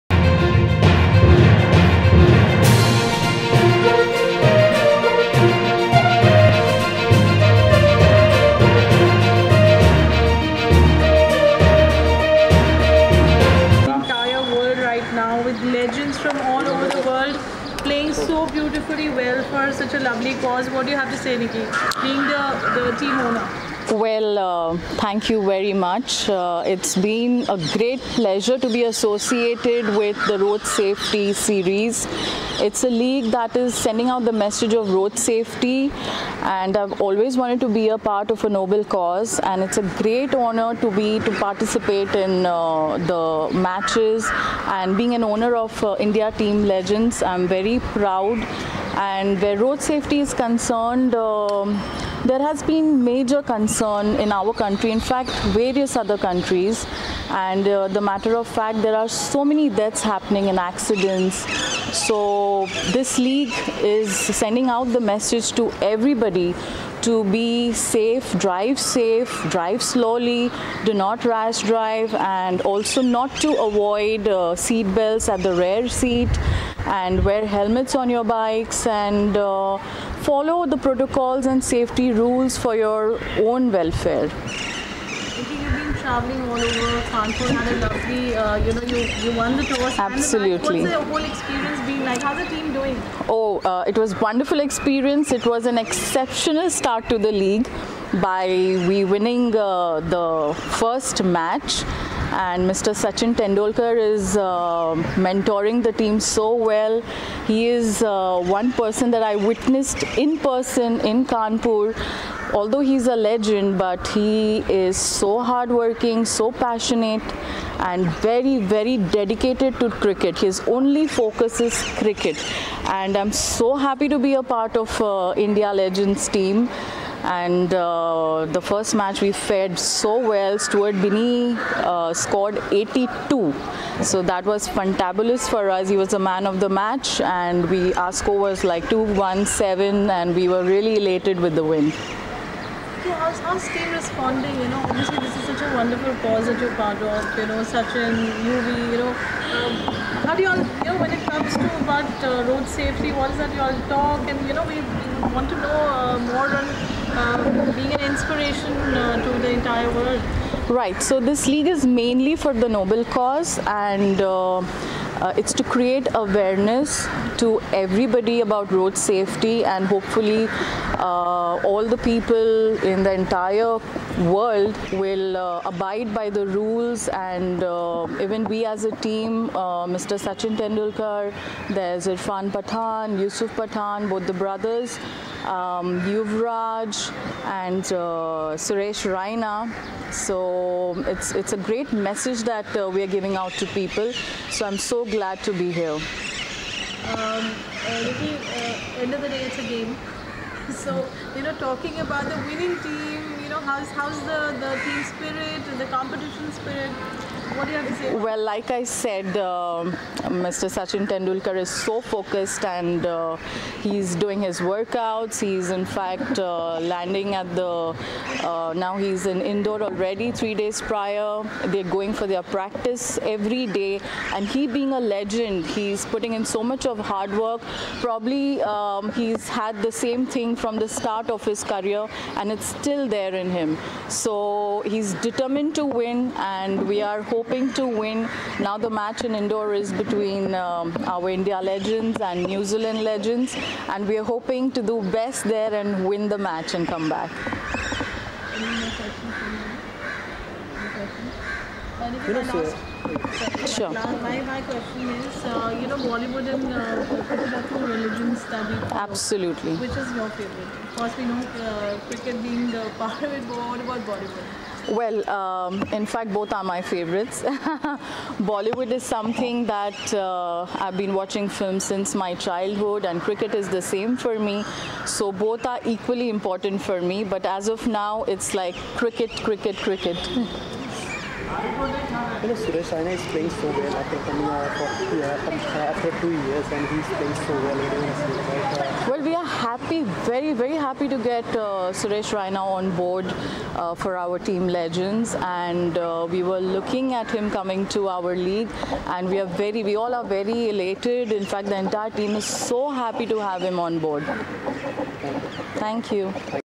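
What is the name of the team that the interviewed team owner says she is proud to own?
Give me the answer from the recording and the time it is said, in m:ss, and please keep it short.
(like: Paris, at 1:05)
India Team Legends, at 0:45.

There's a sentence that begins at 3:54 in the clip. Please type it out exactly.
So he's determined to win and we are hoping to win.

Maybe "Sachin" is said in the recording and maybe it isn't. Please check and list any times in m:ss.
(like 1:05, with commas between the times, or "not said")
1:43, 2:27, 3:00, 3:30.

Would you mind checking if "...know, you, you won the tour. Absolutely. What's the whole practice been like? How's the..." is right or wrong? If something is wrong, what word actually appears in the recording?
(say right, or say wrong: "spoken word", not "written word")
wrong: "experience", not "practice".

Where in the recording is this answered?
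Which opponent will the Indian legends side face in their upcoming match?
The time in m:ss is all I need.
4:02.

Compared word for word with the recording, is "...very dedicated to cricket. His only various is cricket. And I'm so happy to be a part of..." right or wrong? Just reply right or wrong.
wrong.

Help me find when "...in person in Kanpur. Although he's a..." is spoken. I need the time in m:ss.
1:50.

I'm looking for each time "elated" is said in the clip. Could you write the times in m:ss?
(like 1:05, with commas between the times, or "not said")
2:20, 5:00.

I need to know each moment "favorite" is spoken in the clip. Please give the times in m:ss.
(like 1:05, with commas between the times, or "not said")
4:20, 4:26.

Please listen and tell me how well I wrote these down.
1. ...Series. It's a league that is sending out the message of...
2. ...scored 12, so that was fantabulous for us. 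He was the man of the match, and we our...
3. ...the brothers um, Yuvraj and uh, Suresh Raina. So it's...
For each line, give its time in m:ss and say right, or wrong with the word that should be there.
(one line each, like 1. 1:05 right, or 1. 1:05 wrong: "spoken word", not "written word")
1. 0:31 right
2. 2:12 wrong: "82", not "12"
3. 3:04 right.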